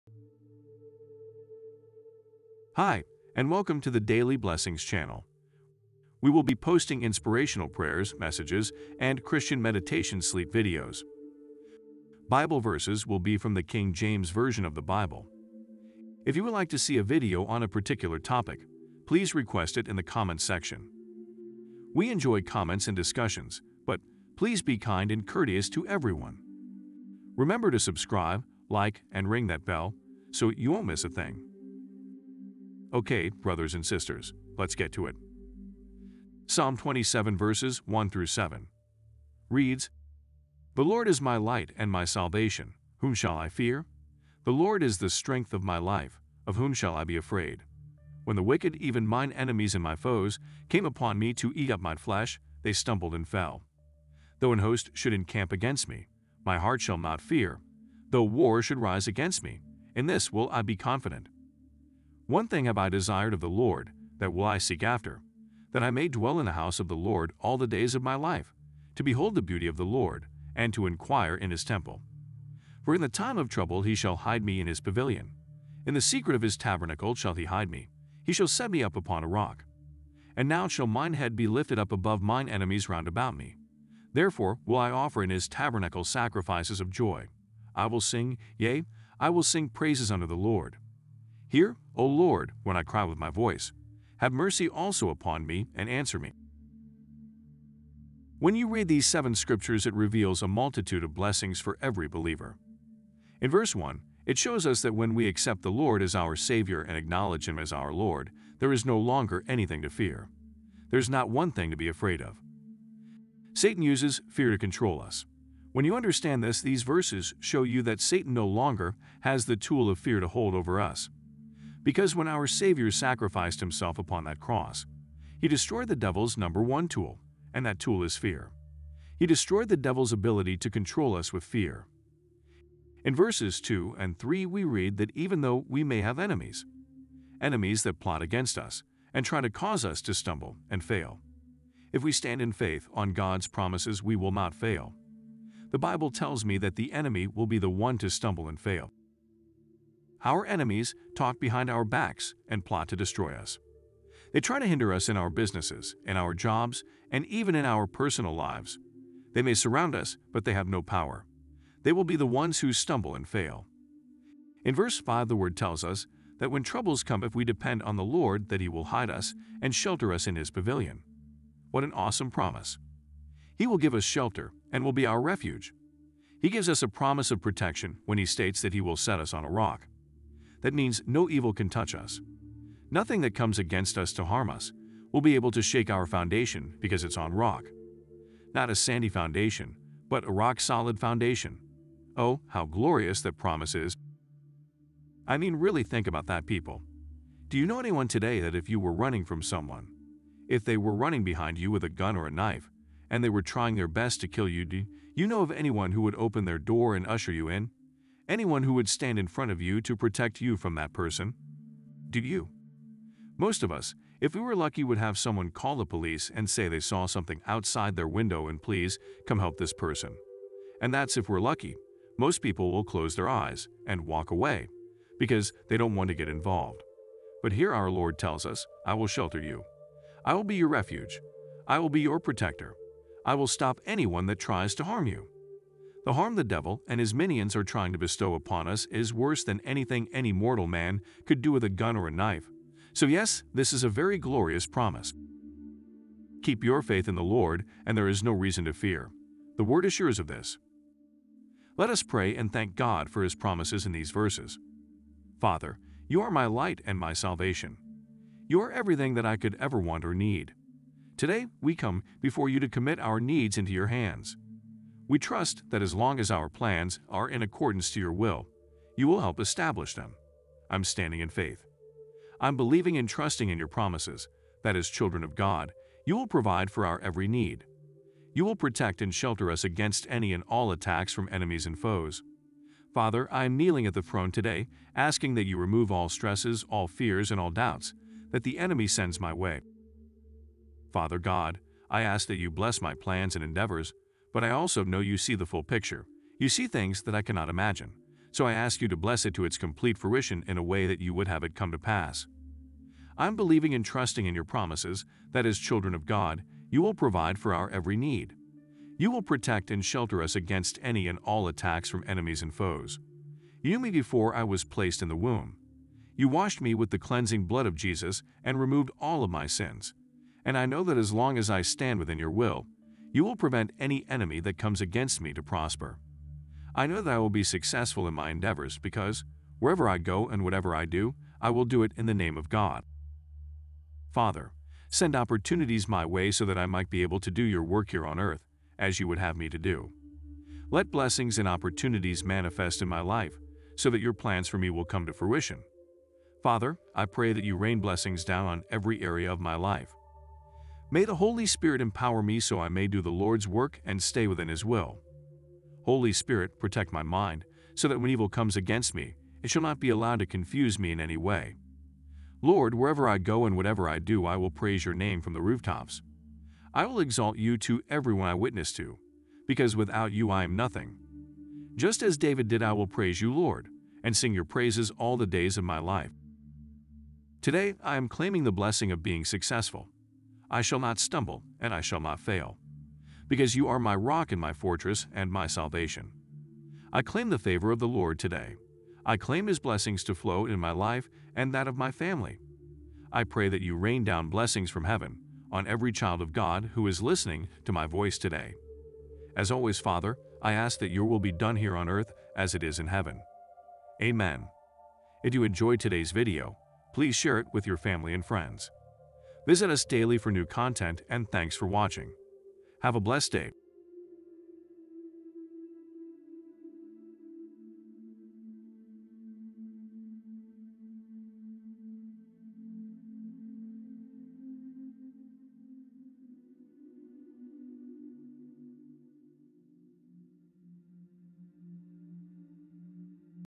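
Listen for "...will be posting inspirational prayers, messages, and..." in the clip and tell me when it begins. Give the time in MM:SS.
00:06.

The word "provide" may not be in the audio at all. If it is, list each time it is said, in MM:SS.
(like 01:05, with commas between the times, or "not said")
04:36, 05:06.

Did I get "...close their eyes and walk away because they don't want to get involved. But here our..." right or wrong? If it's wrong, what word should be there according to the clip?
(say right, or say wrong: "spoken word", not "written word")
right.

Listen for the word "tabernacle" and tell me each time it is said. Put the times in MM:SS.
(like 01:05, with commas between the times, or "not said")
01:16, 01:25.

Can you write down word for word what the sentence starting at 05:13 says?
You knew me before I was placed in the womb.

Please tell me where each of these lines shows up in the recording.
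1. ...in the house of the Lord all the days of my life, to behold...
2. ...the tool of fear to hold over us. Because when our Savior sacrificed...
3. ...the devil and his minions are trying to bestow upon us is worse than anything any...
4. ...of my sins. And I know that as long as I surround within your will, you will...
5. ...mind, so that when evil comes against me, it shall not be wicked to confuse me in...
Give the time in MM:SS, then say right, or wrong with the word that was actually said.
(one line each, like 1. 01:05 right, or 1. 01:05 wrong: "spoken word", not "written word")
1. 01:06 right
2. 01:59 right
3. 03:56 right
4. 05:19 wrong: "stand", not "surround"
5. 05:57 wrong: "allowed", not "wicked".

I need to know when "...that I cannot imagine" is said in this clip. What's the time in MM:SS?
04:57.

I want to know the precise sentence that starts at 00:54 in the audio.
Though an host should encamp against me, my heart shall not fear.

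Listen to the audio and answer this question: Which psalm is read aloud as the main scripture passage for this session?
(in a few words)
Psalm 27.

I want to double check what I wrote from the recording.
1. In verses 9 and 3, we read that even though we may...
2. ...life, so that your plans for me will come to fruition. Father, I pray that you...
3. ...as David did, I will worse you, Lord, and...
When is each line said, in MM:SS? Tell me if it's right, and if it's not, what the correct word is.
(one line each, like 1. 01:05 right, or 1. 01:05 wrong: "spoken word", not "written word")
1. 02:13 wrong: "2", not "9"
2. 05:43 right
3. 06:12 wrong: "praise", not "worse".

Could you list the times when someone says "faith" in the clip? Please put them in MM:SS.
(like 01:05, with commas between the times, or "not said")
02:22, 04:06, 04:31.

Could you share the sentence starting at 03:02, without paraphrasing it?
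Nothing that comes against us to harm us will be able to shake our foundation because it's on rock.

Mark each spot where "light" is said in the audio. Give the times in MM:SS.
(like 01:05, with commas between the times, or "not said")
00:41, 04:16.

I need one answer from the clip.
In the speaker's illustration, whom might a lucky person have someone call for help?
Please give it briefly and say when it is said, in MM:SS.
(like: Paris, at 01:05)
the police, at 03:35.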